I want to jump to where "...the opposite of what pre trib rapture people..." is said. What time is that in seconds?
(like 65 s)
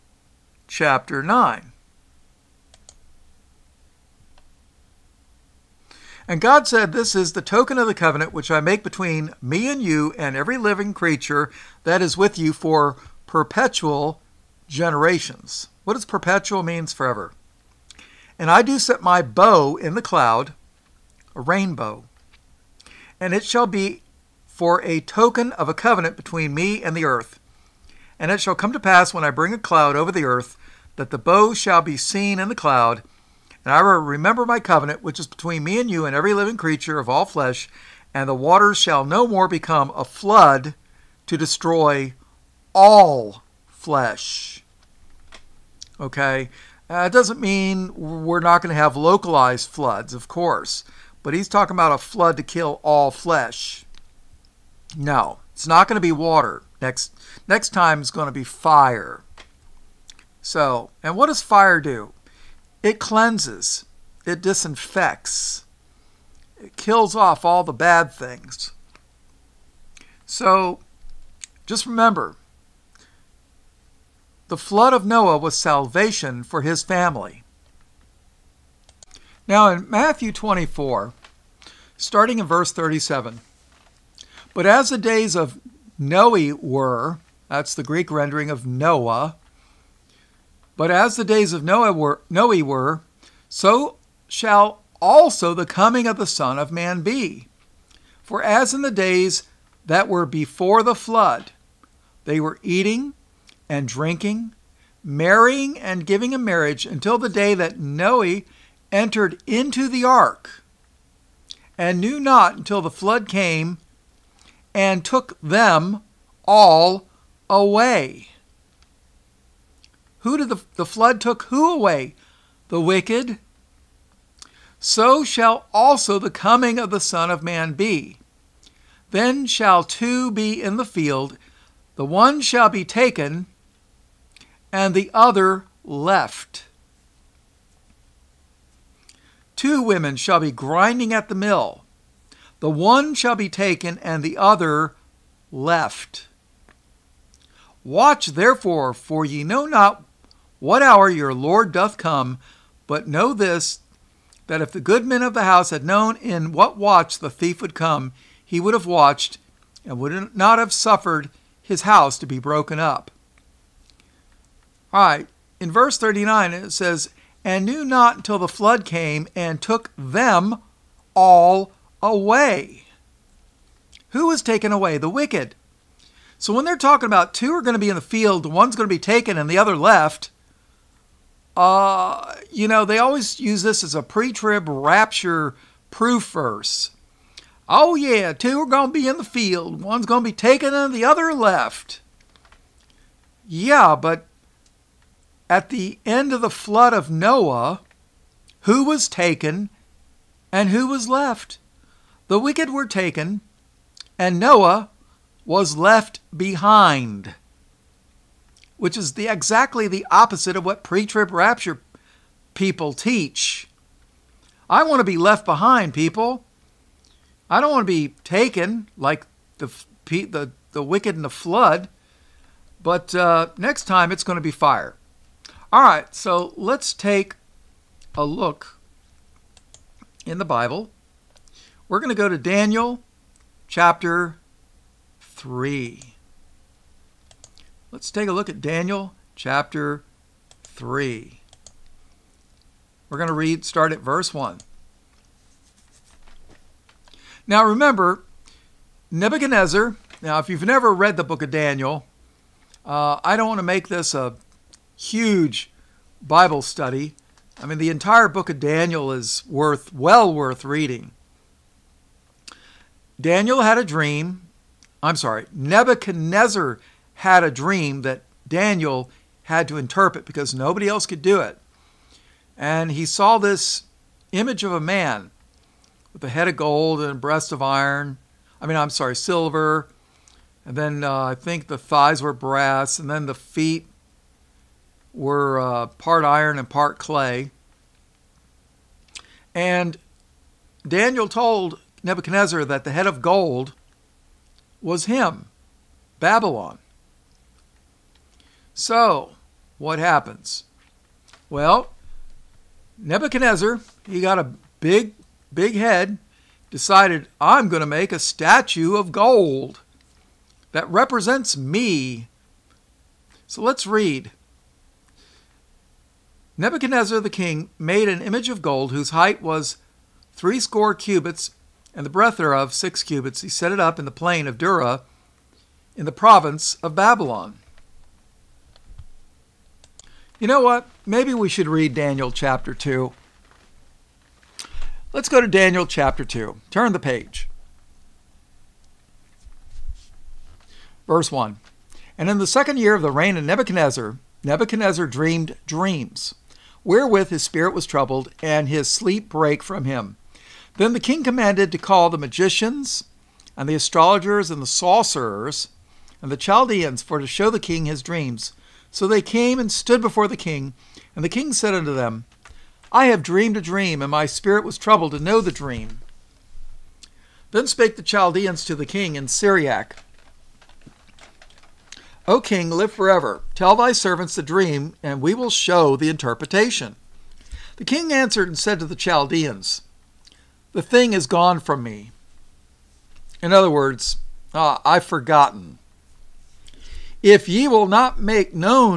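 209 s.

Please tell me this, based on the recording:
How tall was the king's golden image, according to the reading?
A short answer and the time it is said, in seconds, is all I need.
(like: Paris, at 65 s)
Threescore cubits, at 320 s.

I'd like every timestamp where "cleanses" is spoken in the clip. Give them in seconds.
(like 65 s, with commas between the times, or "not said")
62 s.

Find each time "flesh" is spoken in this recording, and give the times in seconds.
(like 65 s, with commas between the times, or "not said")
37 s, 43 s, 53 s.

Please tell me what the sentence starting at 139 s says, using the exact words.
Two women shall be grinding at the mill.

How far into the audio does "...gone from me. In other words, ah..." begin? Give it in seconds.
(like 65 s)
381 s.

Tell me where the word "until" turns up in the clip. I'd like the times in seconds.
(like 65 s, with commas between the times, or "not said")
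106 s, 112 s, 168 s.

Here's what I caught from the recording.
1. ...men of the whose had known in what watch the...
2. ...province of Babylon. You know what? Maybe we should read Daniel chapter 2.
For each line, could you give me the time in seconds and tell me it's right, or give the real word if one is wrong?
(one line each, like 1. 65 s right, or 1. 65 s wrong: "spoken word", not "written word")
1. 155 s wrong: "house", not "whose"
2. 326 s right.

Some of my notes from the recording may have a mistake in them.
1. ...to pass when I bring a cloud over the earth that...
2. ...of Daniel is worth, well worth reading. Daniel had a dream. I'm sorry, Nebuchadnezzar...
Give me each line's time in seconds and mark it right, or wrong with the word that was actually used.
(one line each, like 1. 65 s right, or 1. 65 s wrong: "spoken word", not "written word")
1. 28 s right
2. 258 s right.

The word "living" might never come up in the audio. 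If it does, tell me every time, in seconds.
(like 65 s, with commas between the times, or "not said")
10 s, 36 s.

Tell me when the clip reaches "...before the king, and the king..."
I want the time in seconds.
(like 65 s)
360 s.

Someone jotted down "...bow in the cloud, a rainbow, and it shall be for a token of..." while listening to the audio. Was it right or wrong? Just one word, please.
right.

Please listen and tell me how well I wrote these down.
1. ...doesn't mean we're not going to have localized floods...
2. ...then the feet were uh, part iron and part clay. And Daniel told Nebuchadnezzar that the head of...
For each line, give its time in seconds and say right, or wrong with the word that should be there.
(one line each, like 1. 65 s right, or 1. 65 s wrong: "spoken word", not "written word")
1. 47 s right
2. 283 s right.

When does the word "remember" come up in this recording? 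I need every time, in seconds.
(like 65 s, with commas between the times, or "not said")
33 s, 71 s, 247 s.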